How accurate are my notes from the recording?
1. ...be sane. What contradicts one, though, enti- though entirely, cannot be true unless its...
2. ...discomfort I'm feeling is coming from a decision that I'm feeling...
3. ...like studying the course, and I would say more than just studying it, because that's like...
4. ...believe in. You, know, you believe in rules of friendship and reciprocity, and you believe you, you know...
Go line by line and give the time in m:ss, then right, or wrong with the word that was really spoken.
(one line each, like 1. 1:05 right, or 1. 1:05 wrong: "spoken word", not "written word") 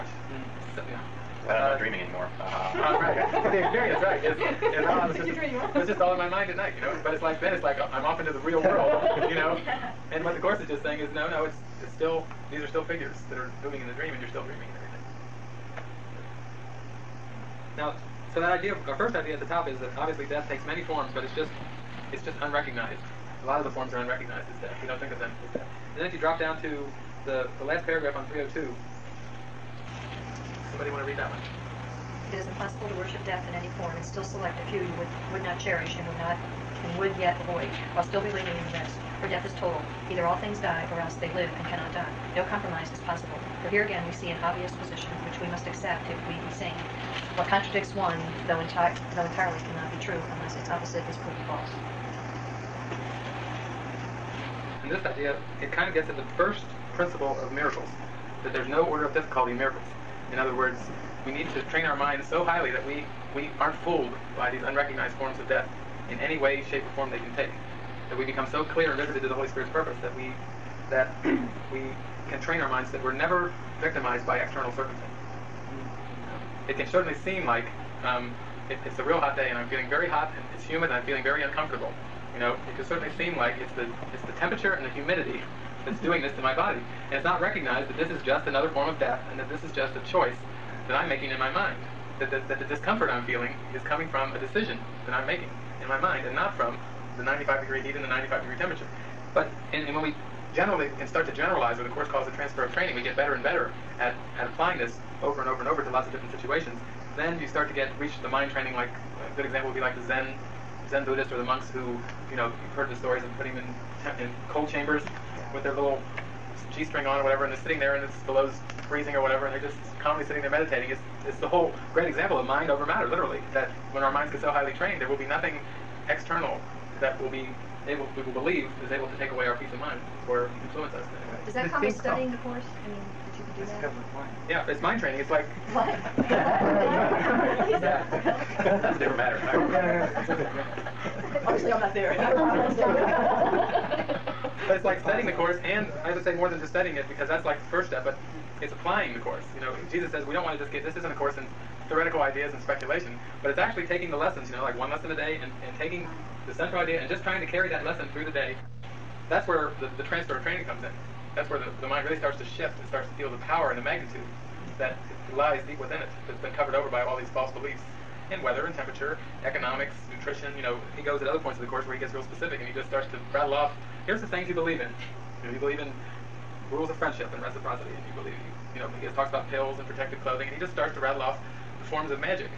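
1. 0:46 right
2. 1:32 wrong: "making", not "feeling"
3. 2:24 right
4. 2:54 right.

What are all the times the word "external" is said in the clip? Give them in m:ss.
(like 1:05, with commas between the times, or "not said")
1:14, 2:06.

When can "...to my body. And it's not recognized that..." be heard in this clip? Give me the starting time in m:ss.
1:26.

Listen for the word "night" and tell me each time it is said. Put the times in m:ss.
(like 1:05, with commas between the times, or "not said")
0:06.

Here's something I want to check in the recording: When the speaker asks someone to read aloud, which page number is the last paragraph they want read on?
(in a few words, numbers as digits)
302.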